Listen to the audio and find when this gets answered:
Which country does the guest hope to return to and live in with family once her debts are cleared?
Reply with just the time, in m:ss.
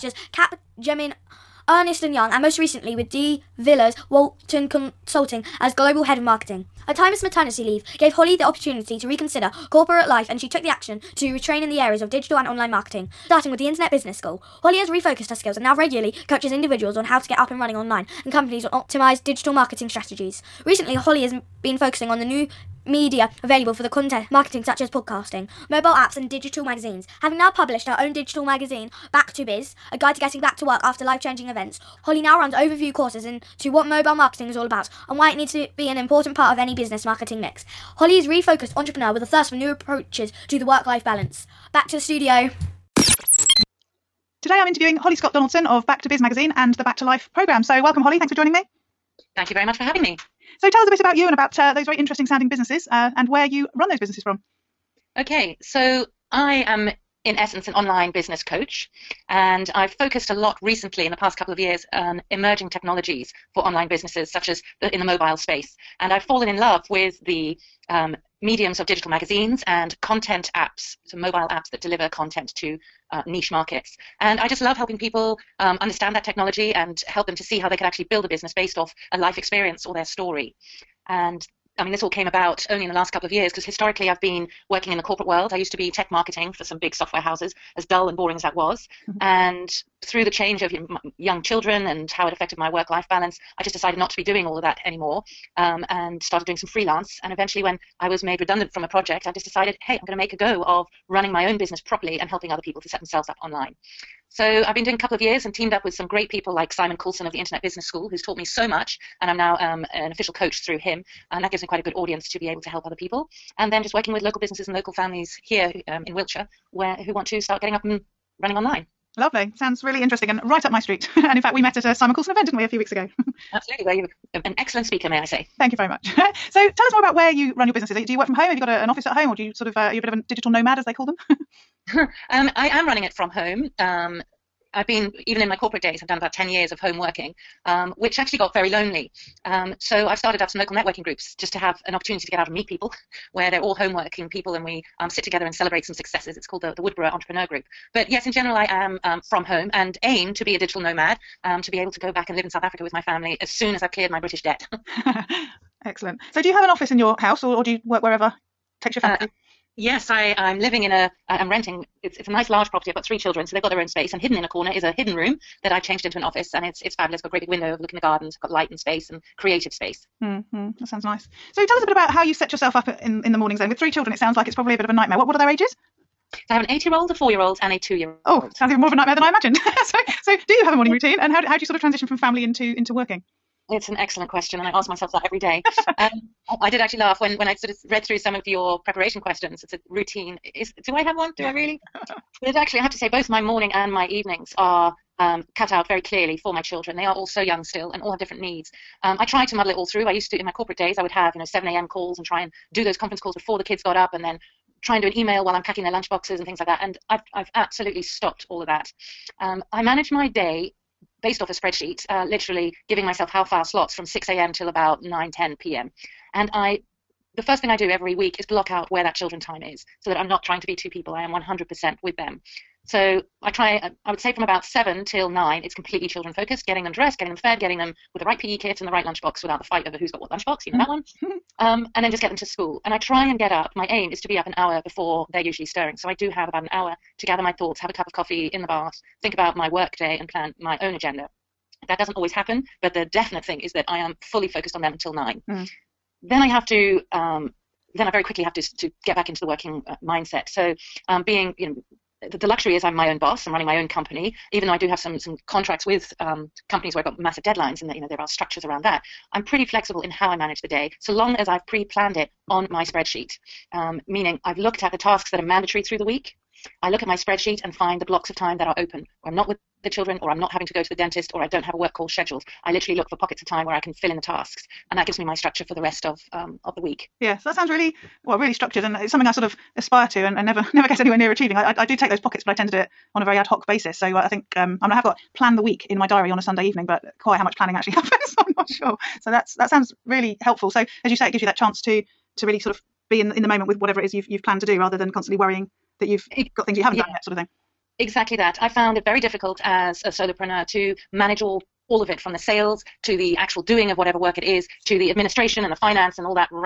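2:32.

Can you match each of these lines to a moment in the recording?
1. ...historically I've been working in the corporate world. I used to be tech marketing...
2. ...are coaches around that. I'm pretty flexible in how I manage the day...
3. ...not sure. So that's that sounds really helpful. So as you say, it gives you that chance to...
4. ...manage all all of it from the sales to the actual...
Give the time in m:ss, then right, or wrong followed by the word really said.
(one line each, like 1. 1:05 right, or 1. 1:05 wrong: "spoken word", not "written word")
1. 1:23 right
2. 4:18 wrong: "structures", not "coaches"
3. 4:48 right
4. 5:01 right.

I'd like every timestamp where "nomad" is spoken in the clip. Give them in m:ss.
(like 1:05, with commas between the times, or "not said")
2:10, 2:30.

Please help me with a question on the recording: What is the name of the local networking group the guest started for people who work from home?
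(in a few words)
Woodborough Entrepreneur Group.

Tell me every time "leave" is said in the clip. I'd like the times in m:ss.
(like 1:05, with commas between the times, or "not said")
0:07.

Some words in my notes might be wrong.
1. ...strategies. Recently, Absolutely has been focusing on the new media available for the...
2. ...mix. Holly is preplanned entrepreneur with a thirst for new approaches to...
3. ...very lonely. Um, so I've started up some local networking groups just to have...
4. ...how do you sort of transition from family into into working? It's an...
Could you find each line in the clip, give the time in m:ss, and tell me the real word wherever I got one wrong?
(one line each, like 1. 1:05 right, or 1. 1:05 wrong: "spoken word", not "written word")
1. 0:19 wrong: "Holly", not "Absolutely"
2. 0:37 wrong: "refocused", not "preplanned"
3. 2:18 right
4. 3:01 right.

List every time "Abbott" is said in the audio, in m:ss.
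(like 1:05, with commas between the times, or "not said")
not said.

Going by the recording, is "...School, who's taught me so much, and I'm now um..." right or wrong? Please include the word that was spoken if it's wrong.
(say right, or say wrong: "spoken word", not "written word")
right.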